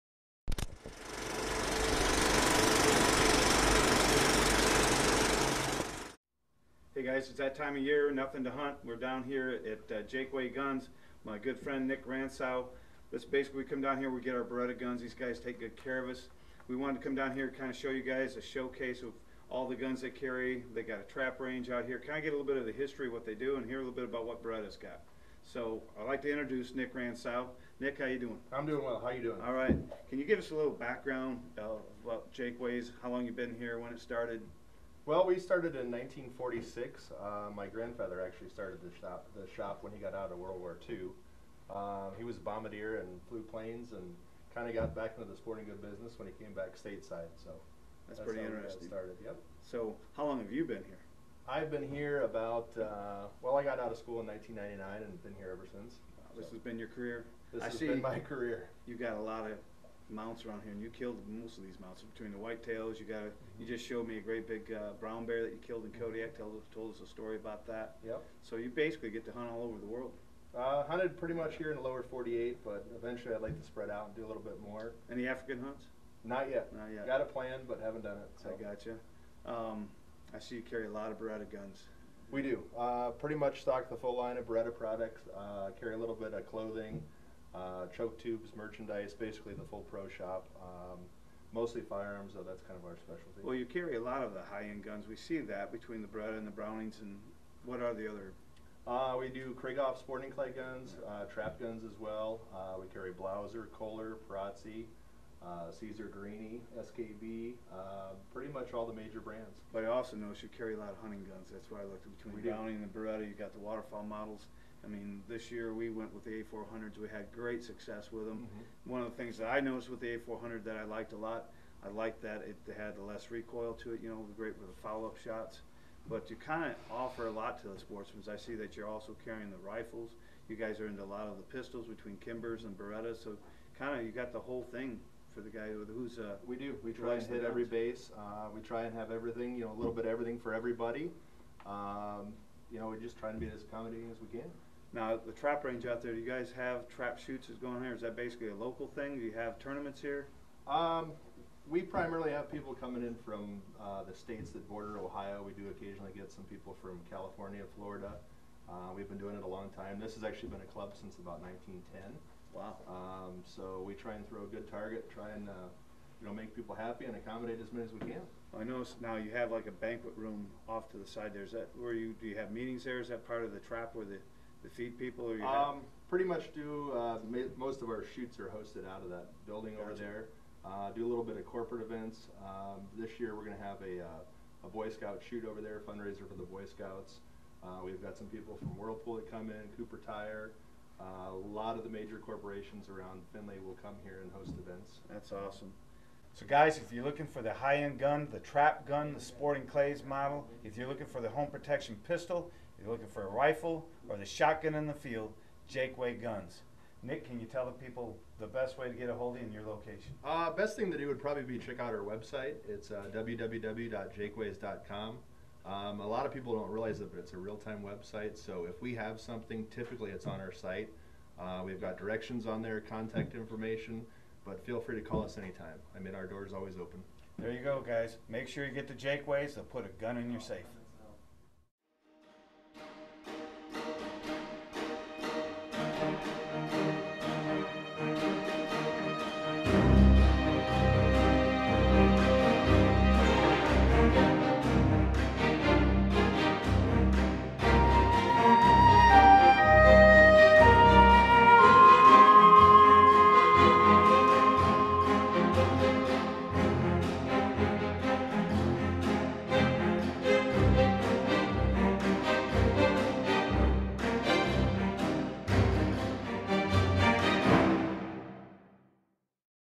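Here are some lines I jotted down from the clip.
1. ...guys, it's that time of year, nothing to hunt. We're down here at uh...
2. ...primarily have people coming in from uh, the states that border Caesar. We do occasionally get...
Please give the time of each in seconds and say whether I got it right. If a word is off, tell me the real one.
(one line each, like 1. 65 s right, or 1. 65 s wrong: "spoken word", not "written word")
1. 7 s right
2. 151 s wrong: "Ohio", not "Caesar".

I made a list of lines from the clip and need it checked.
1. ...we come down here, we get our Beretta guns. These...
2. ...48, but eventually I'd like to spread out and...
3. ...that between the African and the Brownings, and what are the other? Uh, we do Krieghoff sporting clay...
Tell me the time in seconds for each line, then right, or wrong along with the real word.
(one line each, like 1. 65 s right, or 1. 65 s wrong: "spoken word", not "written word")
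1. 13 s right
2. 72 s right
3. 95 s wrong: "Beretta", not "African".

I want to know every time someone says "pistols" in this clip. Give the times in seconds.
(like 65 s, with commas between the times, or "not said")
131 s, 202 s.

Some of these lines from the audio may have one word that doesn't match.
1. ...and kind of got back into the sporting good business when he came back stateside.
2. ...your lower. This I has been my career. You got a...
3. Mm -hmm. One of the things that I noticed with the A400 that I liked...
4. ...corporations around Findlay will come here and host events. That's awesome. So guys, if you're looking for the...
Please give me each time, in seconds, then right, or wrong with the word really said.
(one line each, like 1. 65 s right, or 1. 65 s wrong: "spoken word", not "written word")
1. 43 s right
2. 56 s wrong: "career", not "lower"
3. 118 s right
4. 192 s right.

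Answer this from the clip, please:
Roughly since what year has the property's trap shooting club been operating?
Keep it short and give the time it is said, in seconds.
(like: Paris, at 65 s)
1910, at 161 s.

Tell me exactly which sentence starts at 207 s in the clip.
Nick, can you tell the people the best way to get a hold of you and your location?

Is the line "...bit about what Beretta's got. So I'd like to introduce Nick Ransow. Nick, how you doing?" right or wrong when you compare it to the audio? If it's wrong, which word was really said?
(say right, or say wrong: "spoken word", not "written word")
right.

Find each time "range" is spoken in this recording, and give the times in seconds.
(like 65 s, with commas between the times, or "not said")
21 s, 145 s.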